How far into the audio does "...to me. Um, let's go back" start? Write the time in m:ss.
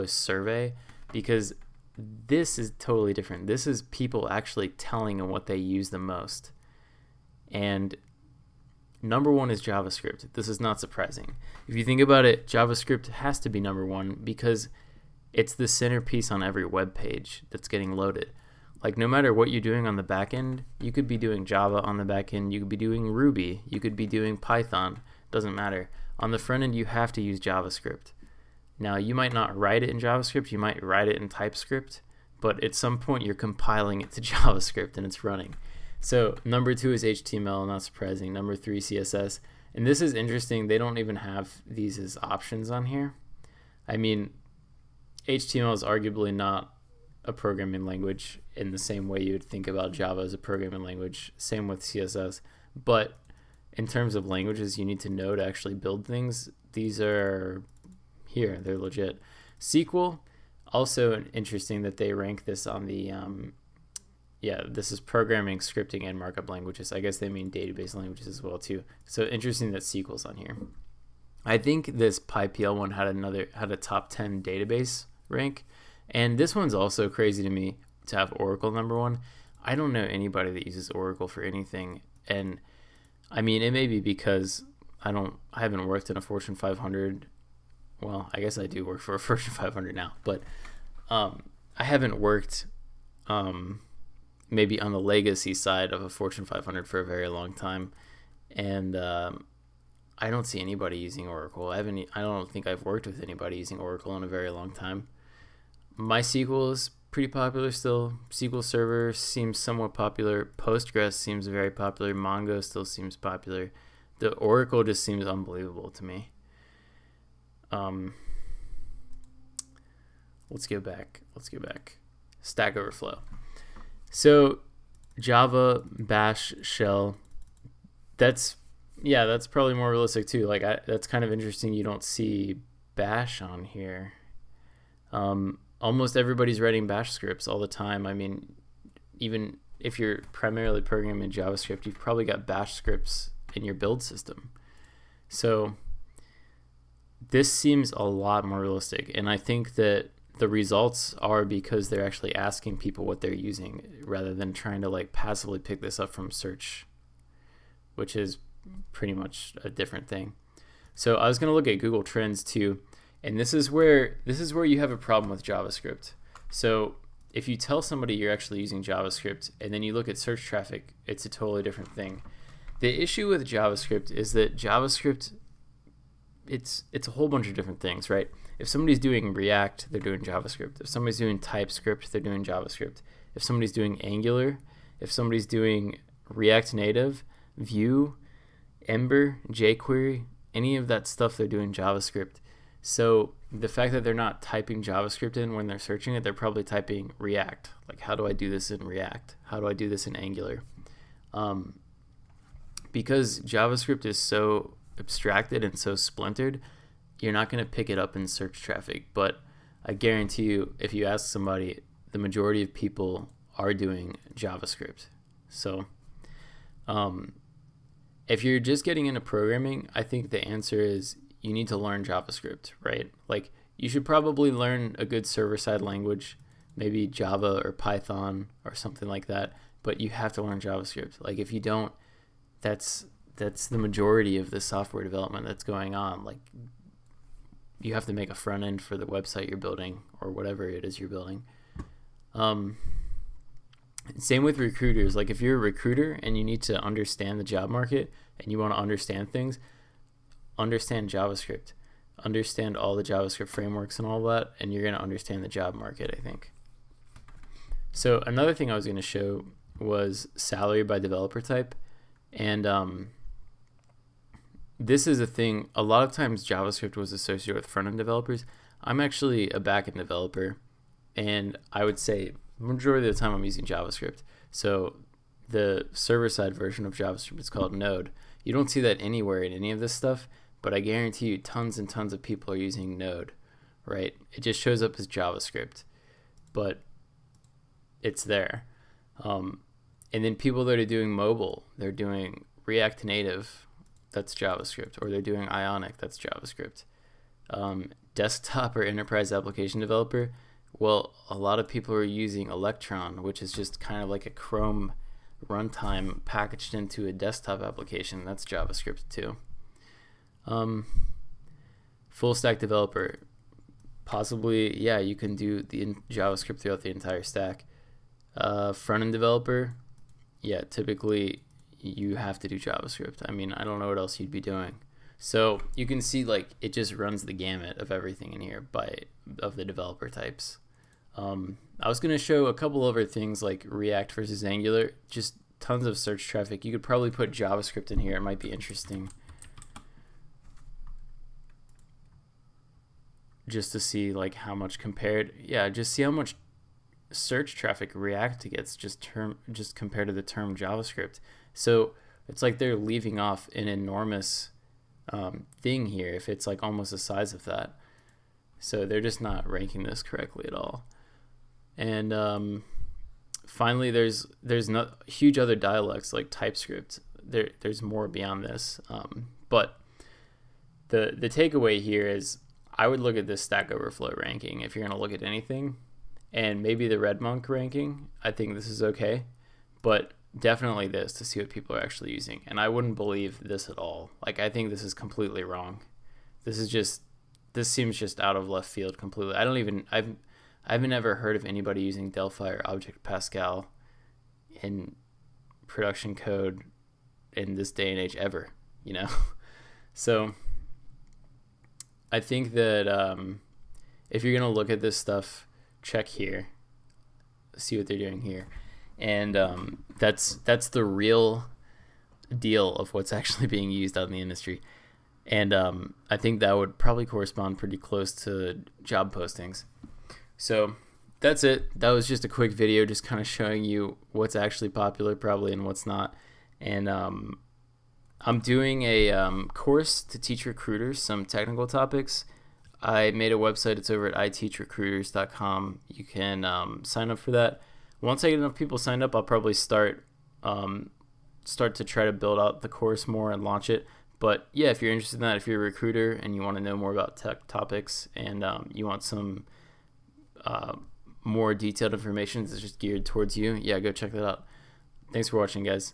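1:55.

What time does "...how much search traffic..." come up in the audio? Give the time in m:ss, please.
5:46.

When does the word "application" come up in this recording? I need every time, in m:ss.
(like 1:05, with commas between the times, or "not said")
4:59, 5:07.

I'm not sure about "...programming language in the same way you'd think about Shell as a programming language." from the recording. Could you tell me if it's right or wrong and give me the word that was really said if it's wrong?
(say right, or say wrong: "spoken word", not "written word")
wrong: "Java", not "Shell".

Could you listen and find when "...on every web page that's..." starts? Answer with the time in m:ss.
0:16.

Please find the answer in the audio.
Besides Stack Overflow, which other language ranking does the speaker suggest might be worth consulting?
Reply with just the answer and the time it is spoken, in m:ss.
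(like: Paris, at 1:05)
RedMonk, at 6:16.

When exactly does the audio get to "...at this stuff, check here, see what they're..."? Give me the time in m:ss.
6:44.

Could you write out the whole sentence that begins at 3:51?
Like, if you don't, that's that's the majority of the software development that's going on.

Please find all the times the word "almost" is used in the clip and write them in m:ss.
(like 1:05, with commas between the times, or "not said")
2:15, 5:56.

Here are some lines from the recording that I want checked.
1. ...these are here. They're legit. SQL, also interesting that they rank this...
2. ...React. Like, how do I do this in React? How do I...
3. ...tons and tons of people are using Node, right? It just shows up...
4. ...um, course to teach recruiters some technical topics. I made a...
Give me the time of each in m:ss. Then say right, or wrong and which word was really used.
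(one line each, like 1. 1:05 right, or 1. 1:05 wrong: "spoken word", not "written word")
1. 0:56 right
2. 3:17 right
3. 4:41 right
4. 7:09 right.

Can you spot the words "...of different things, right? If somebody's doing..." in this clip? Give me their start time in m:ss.
2:57.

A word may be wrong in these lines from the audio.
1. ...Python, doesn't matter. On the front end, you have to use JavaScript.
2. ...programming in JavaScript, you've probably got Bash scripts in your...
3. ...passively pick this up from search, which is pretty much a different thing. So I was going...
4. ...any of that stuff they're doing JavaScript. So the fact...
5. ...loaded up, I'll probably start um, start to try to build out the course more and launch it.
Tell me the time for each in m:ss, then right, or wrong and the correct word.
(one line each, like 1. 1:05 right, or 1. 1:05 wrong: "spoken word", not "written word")
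1. 0:24 right
2. 2:20 right
3. 2:35 right
4. 3:10 right
5. 7:18 wrong: "signed", not "loaded".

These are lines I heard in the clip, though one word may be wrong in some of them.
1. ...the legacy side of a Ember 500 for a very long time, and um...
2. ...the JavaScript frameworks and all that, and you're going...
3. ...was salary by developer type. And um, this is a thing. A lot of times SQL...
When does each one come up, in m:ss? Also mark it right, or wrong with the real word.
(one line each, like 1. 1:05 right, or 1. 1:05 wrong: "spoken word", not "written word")
1. 1:34 wrong: "Fortune", not "Ember"
2. 4:12 right
3. 4:19 wrong: "JavaScript", not "SQL".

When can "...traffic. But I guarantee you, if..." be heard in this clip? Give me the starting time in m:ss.
3:28.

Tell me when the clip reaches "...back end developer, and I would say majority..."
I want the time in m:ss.
4:29.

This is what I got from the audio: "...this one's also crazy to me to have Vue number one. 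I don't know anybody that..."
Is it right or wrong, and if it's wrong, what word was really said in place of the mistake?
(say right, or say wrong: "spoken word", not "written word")
wrong: "Oracle", not "Vue".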